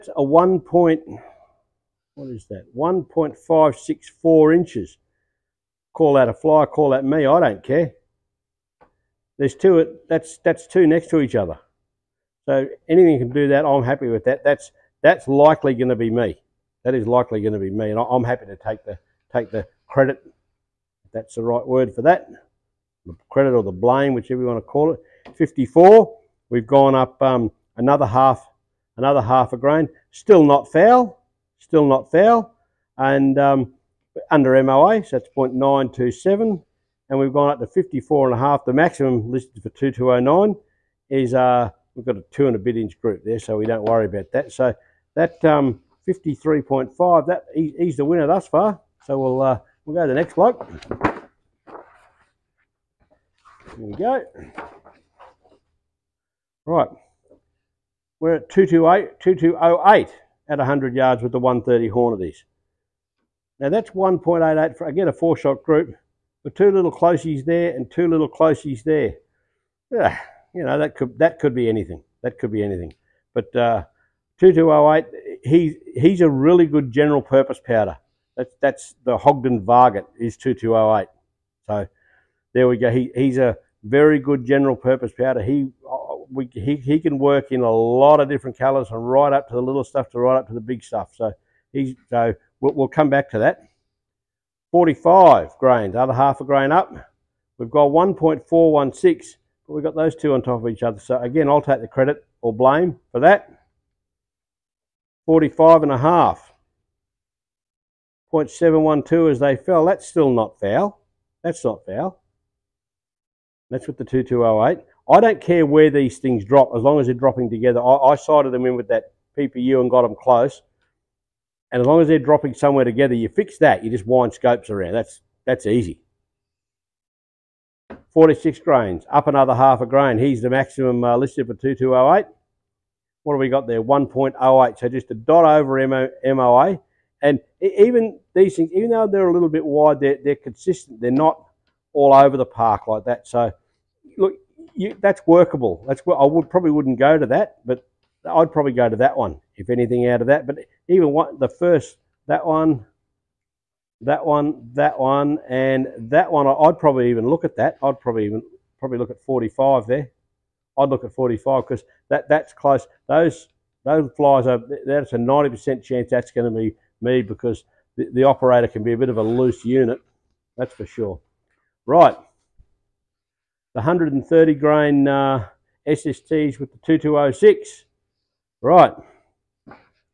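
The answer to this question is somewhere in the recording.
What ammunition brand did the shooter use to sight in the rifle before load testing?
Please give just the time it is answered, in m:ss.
1:59.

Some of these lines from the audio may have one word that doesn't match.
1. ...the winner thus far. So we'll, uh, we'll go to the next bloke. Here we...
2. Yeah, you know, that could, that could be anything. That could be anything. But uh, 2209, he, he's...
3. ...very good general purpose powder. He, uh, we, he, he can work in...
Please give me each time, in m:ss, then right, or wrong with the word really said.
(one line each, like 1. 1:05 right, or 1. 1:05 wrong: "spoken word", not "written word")
1. 0:47 right
2. 1:09 wrong: "2208", not "2209"
3. 1:23 right.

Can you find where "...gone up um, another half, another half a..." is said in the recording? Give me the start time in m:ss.
0:26.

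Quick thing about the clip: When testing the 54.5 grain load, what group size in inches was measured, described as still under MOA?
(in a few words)
0.927.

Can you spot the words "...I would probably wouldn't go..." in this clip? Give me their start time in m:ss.
2:26.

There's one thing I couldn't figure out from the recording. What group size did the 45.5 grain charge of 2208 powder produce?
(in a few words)
0.712.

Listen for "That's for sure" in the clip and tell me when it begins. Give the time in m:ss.
2:50.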